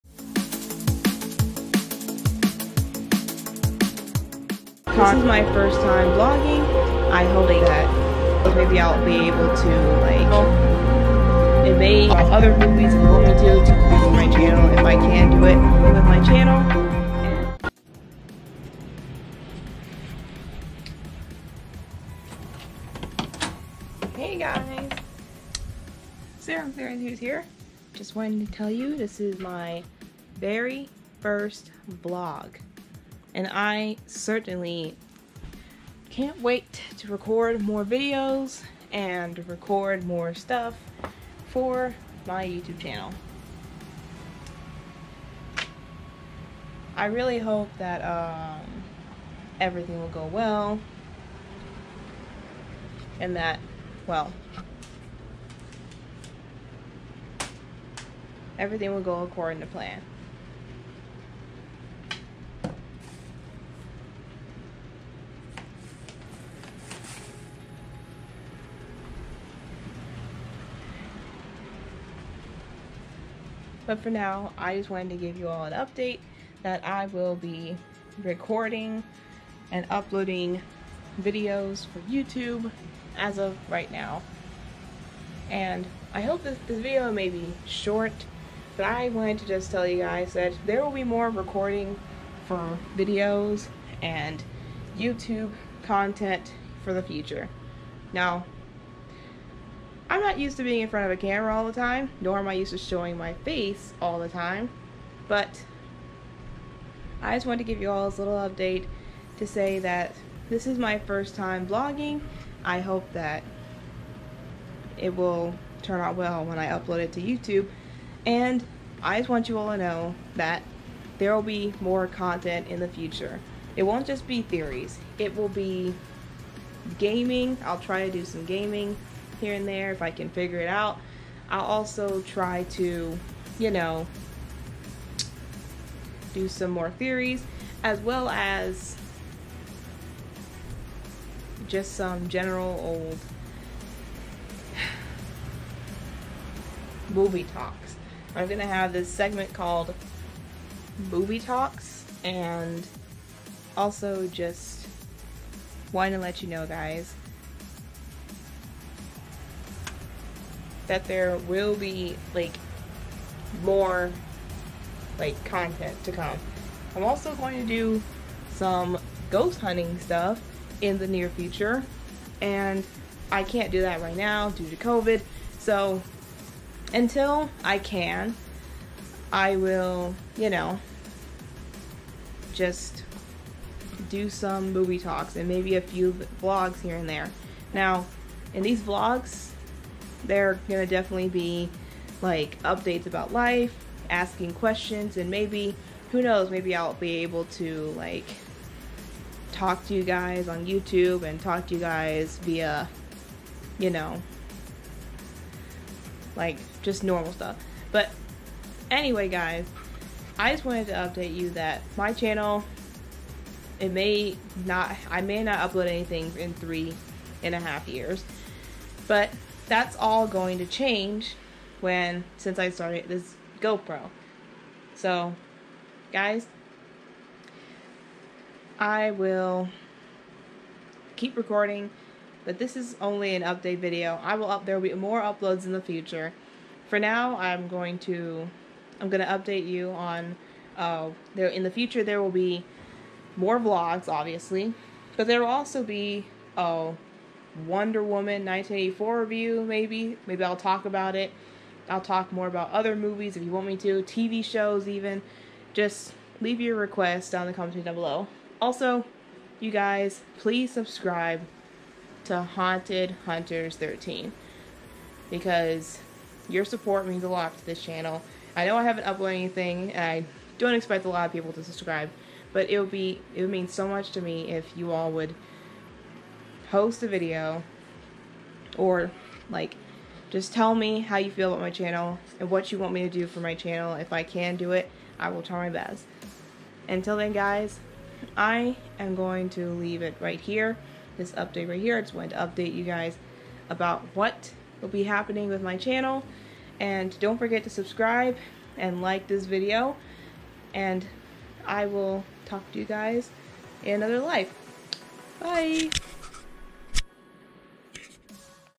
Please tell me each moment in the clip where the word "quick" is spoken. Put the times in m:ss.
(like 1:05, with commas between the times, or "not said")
not said.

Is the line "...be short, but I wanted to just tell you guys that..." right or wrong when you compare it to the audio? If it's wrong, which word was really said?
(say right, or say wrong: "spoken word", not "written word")
right.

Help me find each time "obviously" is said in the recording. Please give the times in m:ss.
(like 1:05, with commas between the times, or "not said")
4:04.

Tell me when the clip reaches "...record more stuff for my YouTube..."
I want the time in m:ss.
0:39.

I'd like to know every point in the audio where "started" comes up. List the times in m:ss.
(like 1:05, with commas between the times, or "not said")
3:42.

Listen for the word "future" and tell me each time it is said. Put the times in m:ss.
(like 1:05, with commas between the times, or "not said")
1:37, 2:02, 2:51, 3:55, 4:01.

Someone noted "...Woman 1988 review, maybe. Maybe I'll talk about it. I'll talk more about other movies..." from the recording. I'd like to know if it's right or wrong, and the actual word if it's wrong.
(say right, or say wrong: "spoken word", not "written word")
wrong: "1984", not "1988".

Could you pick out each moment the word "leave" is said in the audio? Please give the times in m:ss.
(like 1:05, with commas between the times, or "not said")
4:16, 4:49.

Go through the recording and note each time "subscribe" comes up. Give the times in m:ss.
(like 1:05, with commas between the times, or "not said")
4:20, 4:31, 4:57.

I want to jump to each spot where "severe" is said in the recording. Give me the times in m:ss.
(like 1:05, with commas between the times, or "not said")
not said.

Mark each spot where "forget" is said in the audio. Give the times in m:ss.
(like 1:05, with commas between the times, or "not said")
4:57.